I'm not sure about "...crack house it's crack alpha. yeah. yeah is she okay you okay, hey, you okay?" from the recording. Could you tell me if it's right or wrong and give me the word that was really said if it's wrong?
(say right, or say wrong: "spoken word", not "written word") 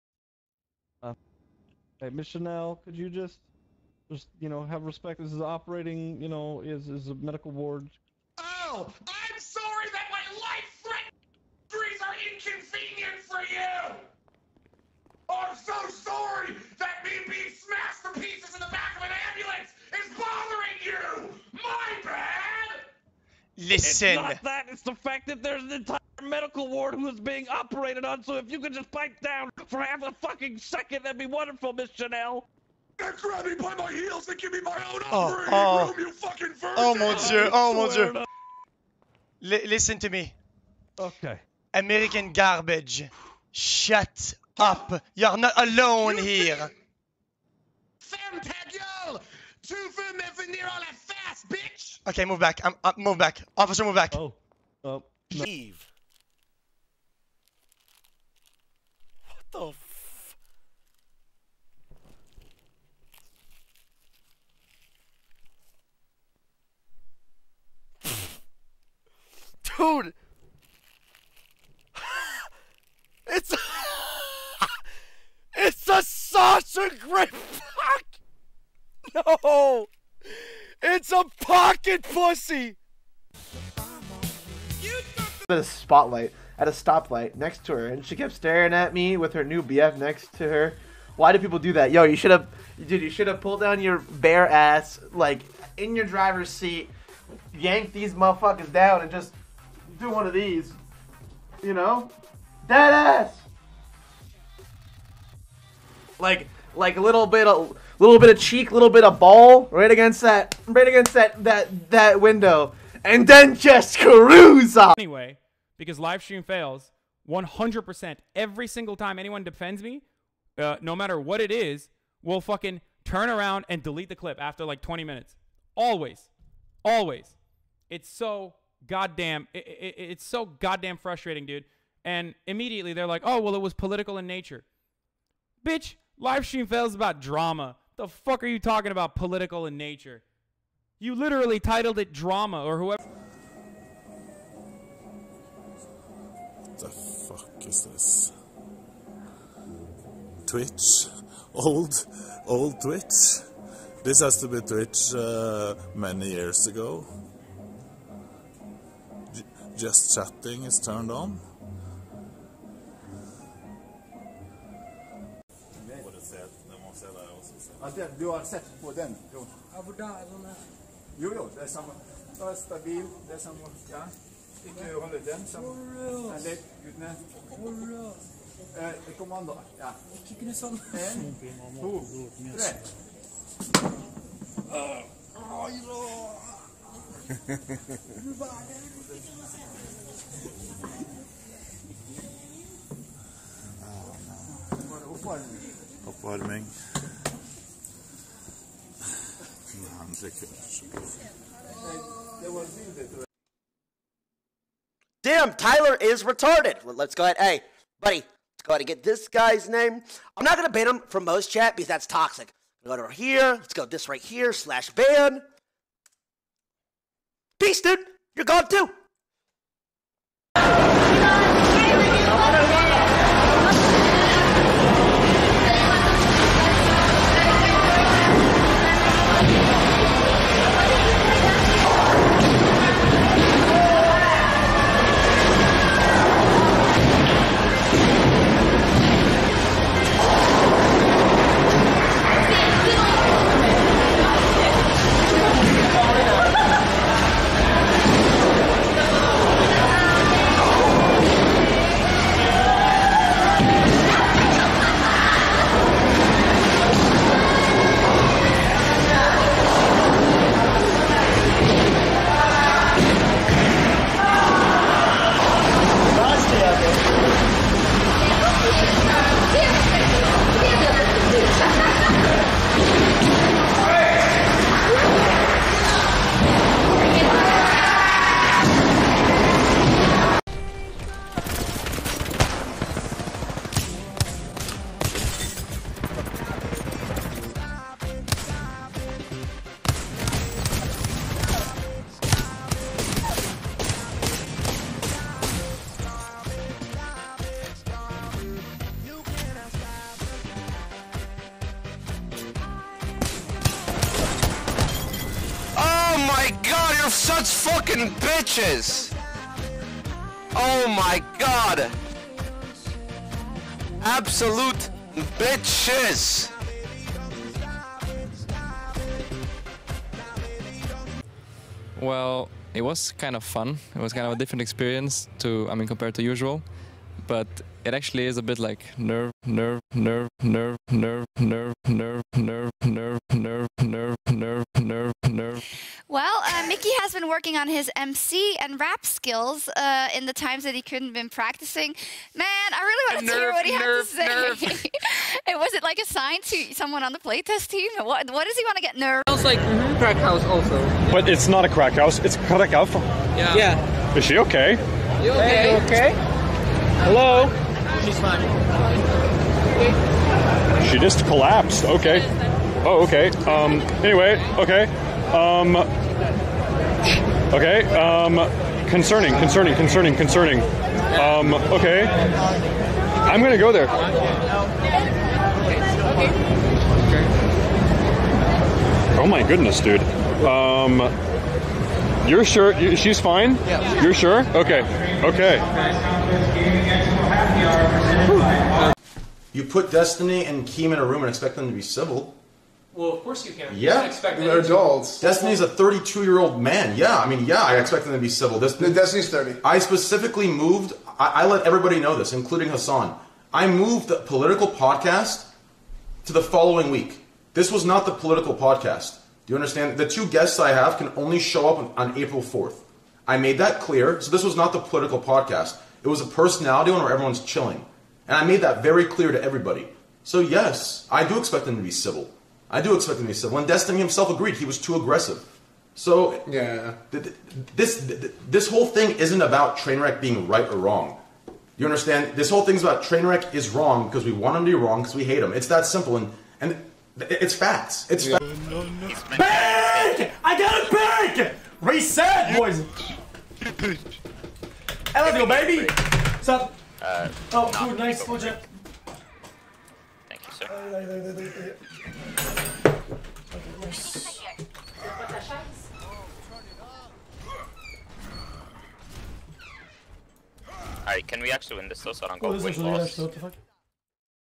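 right.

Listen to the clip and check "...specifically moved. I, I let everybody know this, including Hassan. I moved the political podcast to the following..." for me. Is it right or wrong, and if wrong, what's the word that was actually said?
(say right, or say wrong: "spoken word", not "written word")
right.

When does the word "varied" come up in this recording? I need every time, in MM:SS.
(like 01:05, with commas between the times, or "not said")
not said.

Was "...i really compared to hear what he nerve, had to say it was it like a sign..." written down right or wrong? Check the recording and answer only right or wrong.
wrong.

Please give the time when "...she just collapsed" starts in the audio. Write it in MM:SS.
06:00.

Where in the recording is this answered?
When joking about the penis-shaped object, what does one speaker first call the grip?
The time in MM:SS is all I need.
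01:16.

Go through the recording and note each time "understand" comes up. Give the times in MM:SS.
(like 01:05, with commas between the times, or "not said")
06:49, 07:11.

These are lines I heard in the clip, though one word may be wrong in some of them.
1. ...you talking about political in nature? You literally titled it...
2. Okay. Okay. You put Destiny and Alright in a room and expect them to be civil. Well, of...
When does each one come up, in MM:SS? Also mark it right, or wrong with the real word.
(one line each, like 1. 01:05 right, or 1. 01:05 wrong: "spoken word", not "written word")
1. 02:18 right
2. 06:24 wrong: "Keem", not "Alright".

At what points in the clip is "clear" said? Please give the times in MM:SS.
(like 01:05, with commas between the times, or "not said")
06:53, 06:59.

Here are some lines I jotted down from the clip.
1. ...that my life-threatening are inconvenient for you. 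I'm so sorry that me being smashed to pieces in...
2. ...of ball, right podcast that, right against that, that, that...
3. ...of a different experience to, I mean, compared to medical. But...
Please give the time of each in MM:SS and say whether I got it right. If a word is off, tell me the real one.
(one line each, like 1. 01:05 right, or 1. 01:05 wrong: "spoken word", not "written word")
1. 00:09 right
2. 01:49 wrong: "against", not "podcast"
3. 05:24 wrong: "usual", not "medical".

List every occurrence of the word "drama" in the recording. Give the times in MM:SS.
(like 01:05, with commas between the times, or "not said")
02:17, 02:22.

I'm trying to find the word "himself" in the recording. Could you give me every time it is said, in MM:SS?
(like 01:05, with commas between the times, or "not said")
07:03.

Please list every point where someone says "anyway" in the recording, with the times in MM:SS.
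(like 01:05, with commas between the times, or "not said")
01:54, 06:04.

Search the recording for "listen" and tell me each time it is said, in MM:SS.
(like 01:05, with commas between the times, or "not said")
00:23, 00:39.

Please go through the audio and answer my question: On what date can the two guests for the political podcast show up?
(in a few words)
April 4th.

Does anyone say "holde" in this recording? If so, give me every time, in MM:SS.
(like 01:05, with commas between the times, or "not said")
02:55.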